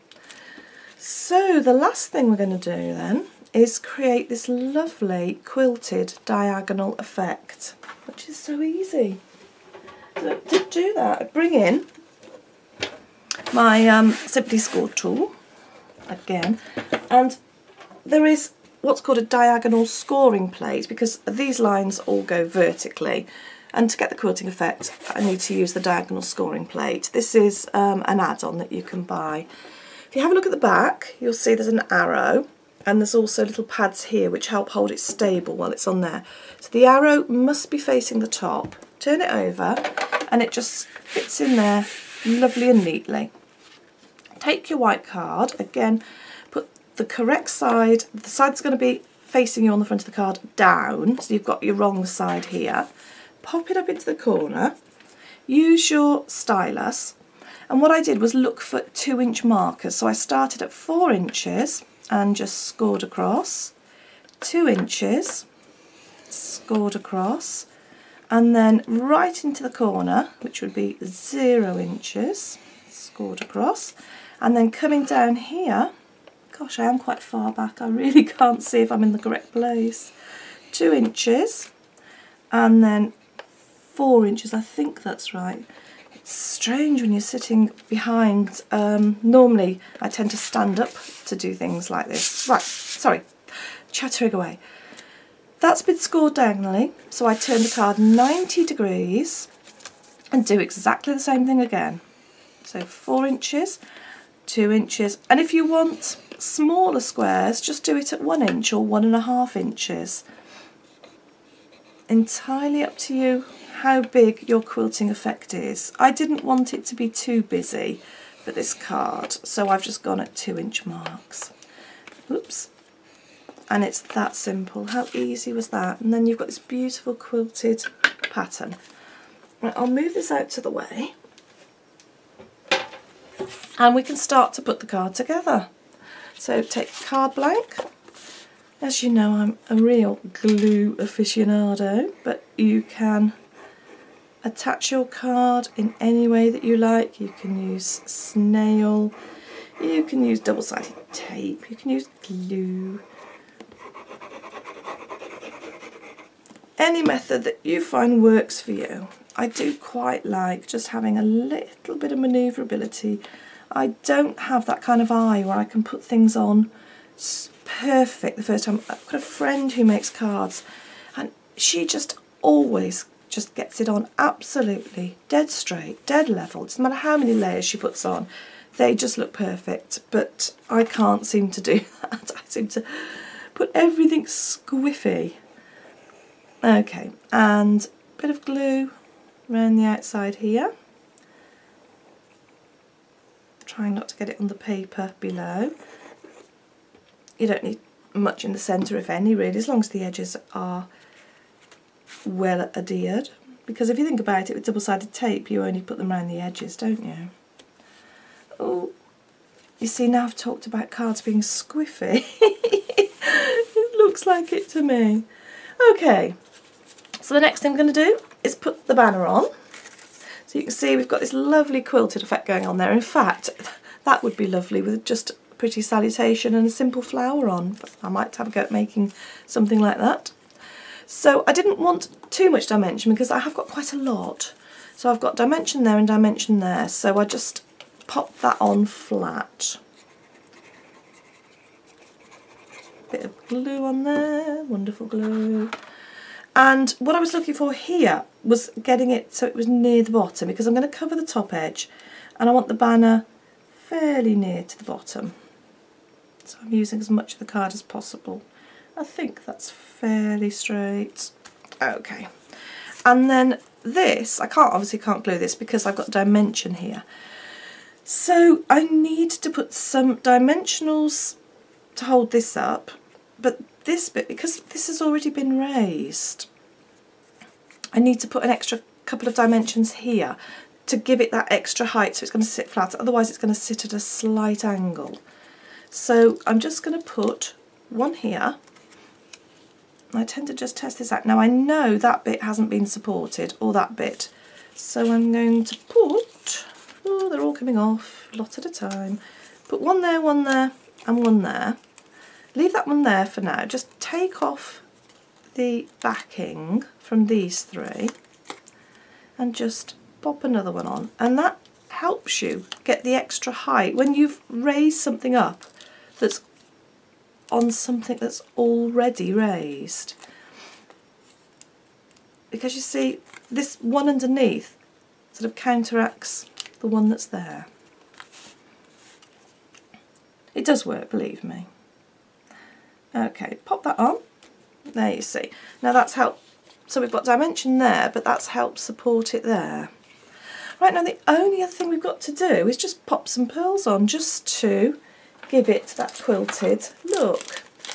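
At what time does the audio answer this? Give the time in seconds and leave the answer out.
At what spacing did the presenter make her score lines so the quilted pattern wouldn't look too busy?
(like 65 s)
120 s.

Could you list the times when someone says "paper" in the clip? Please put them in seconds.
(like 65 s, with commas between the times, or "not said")
194 s.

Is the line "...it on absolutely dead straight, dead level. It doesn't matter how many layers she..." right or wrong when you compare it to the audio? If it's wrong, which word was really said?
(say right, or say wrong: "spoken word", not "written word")
right.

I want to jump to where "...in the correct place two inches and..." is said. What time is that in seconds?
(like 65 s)
79 s.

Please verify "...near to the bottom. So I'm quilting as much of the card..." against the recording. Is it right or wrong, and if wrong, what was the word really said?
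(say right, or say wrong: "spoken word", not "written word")
wrong: "using", not "quilting".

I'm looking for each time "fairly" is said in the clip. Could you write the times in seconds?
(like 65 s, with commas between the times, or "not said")
253 s, 259 s.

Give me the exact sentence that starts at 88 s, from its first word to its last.
Um, normally I tend to stand up to do things like this.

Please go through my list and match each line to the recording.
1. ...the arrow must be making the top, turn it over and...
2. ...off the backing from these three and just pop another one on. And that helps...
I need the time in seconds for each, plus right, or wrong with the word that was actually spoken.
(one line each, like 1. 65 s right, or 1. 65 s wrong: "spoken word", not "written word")
1. 36 s wrong: "facing", not "making"
2. 304 s right.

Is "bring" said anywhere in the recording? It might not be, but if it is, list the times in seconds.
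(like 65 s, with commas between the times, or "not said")
11 s.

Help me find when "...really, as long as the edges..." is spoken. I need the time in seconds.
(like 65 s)
199 s.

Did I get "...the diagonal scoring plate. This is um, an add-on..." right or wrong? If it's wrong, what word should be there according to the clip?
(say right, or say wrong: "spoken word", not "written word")
right.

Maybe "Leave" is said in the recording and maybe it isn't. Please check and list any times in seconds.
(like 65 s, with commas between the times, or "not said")
302 s.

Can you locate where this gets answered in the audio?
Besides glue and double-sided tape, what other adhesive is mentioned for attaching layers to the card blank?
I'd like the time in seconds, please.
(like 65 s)
148 s.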